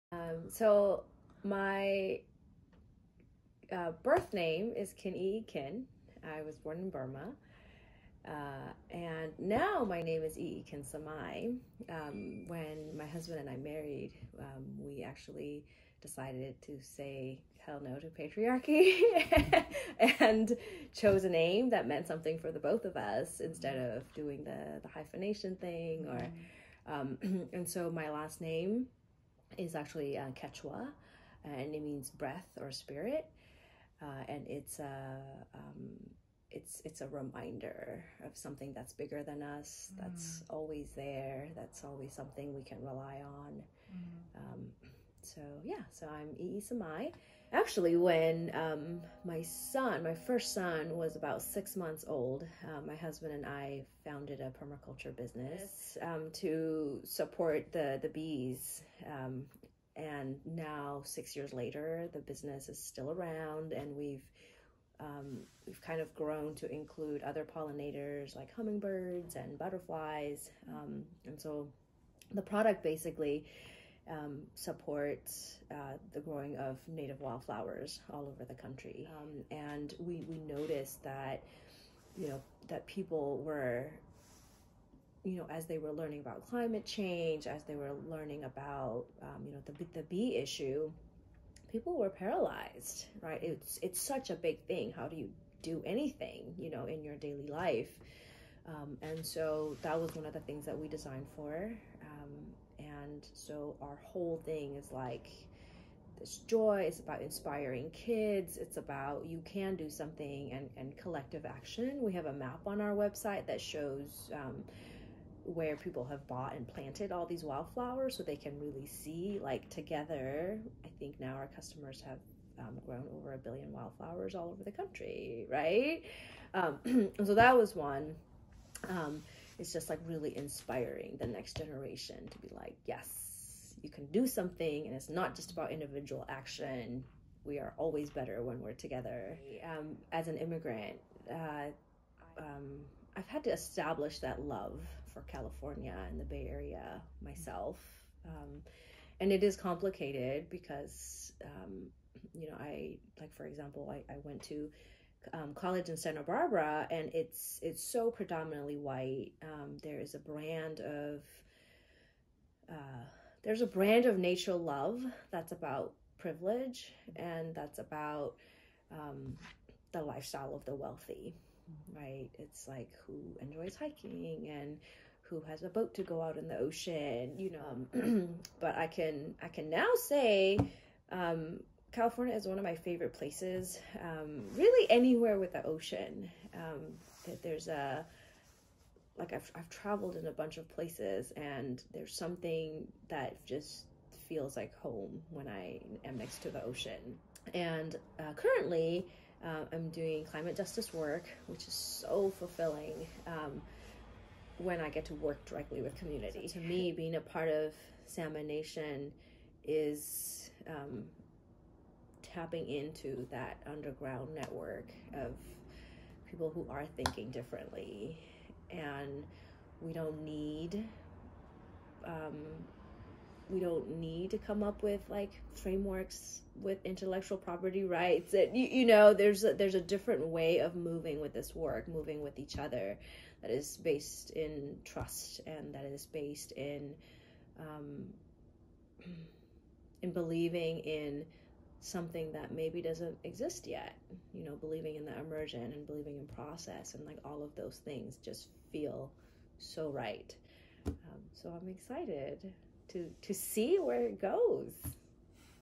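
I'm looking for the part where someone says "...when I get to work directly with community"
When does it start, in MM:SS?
03:24.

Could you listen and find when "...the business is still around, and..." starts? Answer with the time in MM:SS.
01:02.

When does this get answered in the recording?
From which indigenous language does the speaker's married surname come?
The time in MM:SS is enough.
00:30.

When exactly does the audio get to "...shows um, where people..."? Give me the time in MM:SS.
01:53.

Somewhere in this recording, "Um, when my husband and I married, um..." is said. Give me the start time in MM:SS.
00:11.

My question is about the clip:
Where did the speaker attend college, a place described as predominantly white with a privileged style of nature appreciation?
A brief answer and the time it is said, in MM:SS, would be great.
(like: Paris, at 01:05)
Santa Barbara, at 02:35.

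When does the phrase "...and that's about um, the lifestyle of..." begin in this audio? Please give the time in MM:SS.
02:47.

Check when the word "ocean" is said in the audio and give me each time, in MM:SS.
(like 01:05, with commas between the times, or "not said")
02:56, 03:05, 03:16.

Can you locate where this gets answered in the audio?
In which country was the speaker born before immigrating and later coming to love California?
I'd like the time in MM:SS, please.
00:06.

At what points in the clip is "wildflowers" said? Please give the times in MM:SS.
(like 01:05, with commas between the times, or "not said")
01:17, 01:57, 02:03.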